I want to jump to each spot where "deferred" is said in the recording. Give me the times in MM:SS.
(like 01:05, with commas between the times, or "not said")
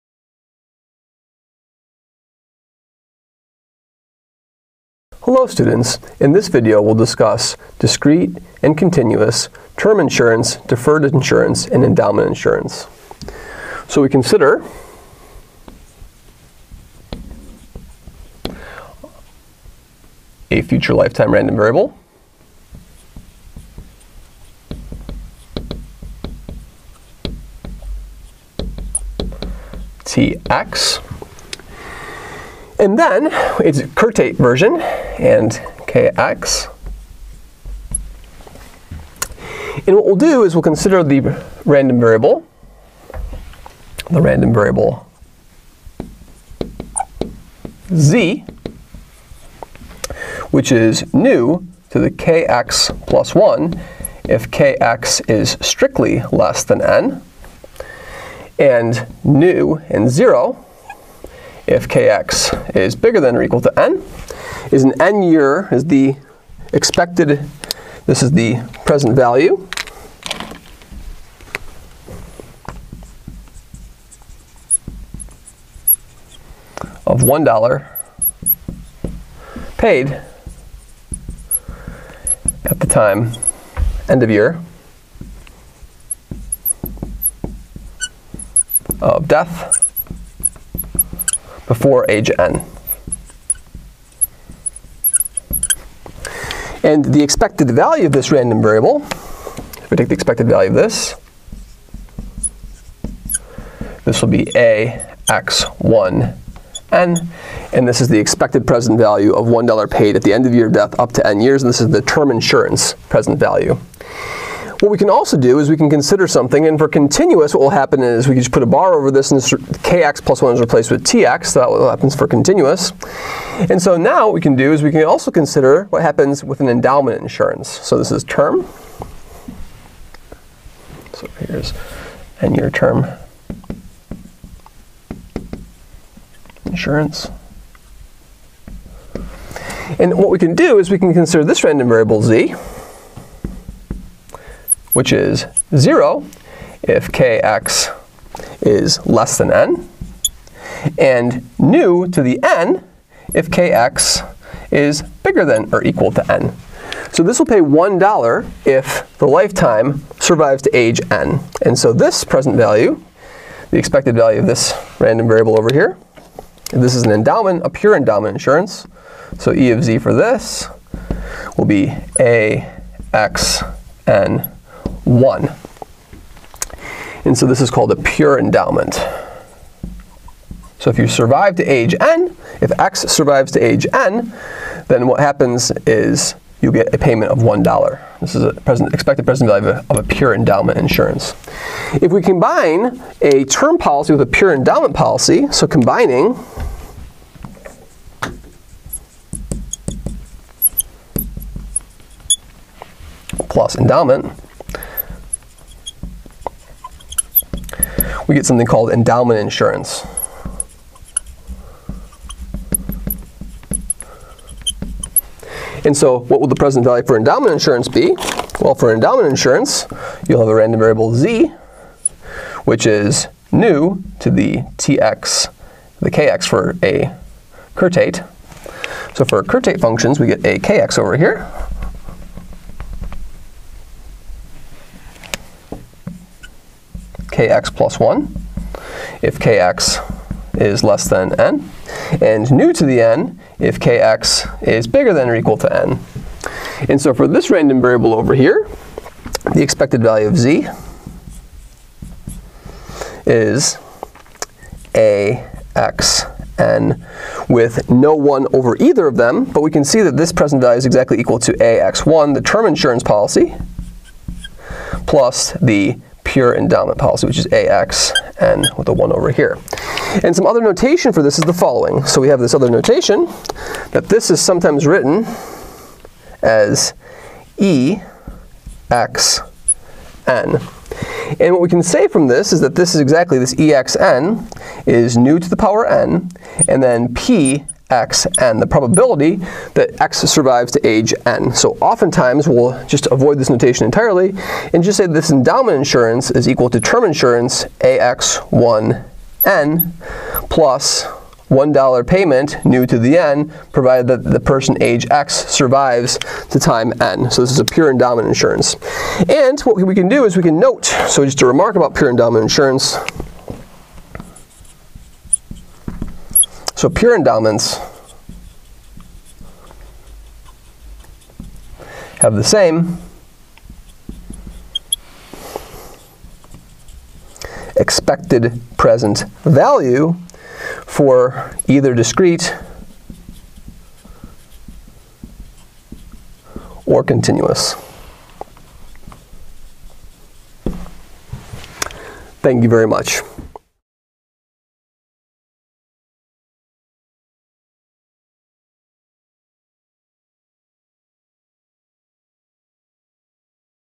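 00:10.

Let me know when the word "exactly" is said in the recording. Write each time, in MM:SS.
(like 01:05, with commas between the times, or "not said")
04:20, 04:43.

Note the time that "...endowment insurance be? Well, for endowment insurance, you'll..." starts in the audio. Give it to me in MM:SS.
03:37.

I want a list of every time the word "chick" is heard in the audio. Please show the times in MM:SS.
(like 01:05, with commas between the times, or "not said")
not said.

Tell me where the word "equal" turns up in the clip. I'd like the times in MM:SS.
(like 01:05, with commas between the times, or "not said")
01:03, 02:35, 04:05, 04:21, 04:56.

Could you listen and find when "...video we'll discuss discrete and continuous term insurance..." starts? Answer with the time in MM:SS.
00:06.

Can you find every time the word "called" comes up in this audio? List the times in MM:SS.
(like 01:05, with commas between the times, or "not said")
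02:57, 03:28.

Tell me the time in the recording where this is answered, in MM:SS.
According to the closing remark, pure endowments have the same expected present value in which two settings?
05:31.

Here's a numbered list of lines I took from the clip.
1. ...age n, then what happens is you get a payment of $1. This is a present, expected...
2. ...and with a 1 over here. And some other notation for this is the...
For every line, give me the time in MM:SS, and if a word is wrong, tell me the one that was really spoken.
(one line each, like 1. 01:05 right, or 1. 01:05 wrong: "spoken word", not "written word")
1. 03:03 right
2. 04:28 right.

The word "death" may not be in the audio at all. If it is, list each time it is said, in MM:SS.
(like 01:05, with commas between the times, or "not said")
01:29, 01:50.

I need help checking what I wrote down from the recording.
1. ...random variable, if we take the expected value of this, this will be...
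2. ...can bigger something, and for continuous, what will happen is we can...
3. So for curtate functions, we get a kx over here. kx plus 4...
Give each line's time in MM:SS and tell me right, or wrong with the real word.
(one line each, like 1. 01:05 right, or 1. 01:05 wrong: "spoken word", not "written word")
1. 01:38 right
2. 01:55 wrong: "consider", not "bigger"
3. 03:49 wrong: "1", not "4".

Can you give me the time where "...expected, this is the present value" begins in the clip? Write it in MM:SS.
01:06.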